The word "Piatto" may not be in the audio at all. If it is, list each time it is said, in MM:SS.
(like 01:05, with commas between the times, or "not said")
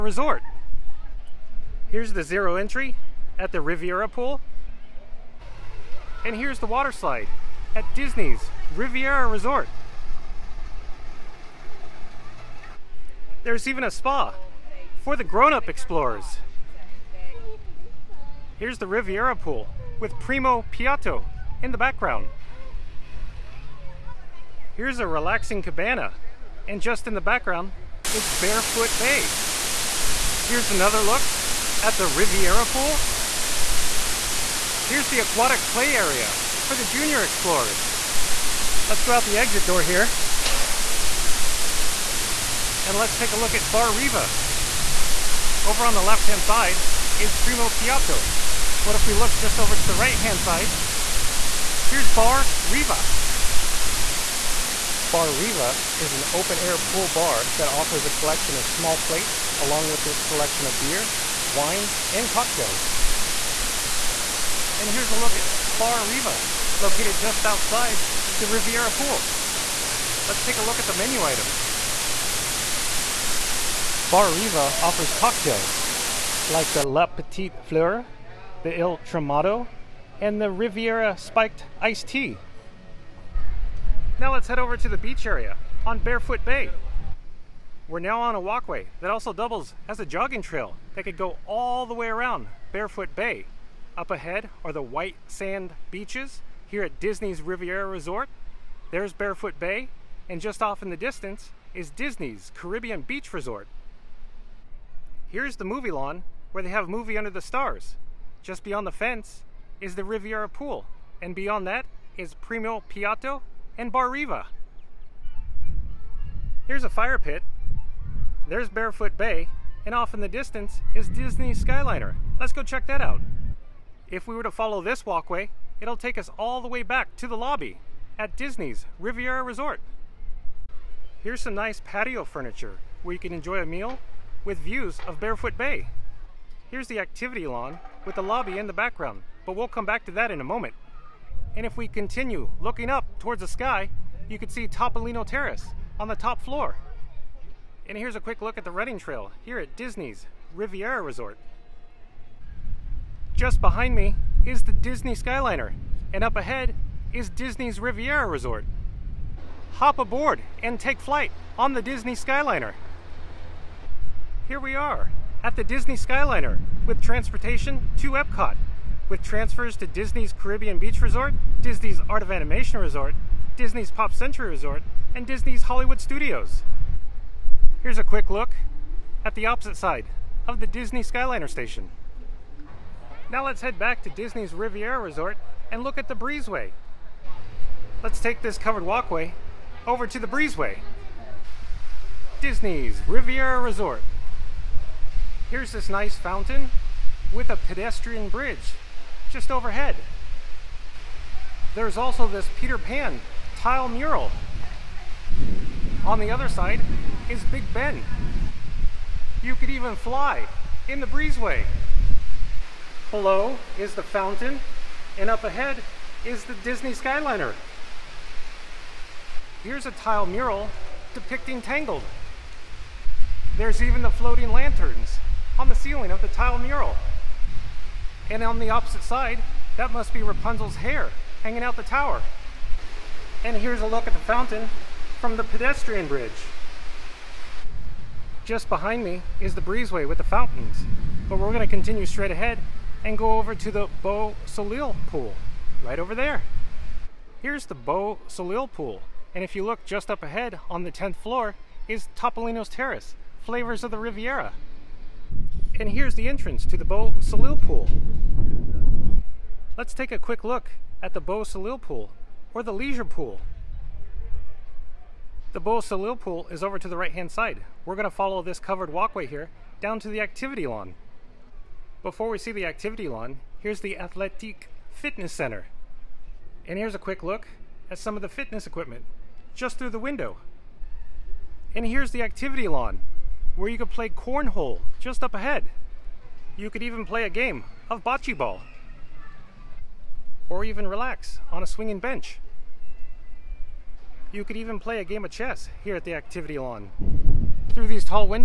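00:20, 00:47, 01:52.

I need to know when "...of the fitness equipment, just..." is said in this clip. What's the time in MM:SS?
04:38.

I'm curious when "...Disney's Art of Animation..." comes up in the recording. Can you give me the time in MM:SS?
02:51.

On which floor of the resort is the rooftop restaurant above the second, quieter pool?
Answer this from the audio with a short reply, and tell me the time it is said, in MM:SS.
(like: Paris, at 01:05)
10th floor, at 04:10.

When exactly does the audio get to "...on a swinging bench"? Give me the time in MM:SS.
04:51.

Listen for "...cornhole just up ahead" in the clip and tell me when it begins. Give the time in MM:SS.
04:44.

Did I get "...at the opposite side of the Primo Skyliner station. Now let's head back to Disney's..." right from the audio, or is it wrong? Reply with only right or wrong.
wrong.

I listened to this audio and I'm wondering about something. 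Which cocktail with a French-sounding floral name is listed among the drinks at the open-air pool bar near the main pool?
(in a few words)
La Petite Fleur.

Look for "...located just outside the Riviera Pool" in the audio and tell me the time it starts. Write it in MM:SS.
01:06.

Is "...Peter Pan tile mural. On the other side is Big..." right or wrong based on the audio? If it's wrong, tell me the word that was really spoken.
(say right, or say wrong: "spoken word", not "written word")
right.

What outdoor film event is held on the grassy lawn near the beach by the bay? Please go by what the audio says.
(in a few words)
Movie Under the Stars.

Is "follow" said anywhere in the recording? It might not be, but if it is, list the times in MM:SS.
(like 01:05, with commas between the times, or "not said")
02:04, 04:28.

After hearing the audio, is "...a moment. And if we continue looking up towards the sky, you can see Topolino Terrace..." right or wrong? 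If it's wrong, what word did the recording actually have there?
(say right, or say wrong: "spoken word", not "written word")
right.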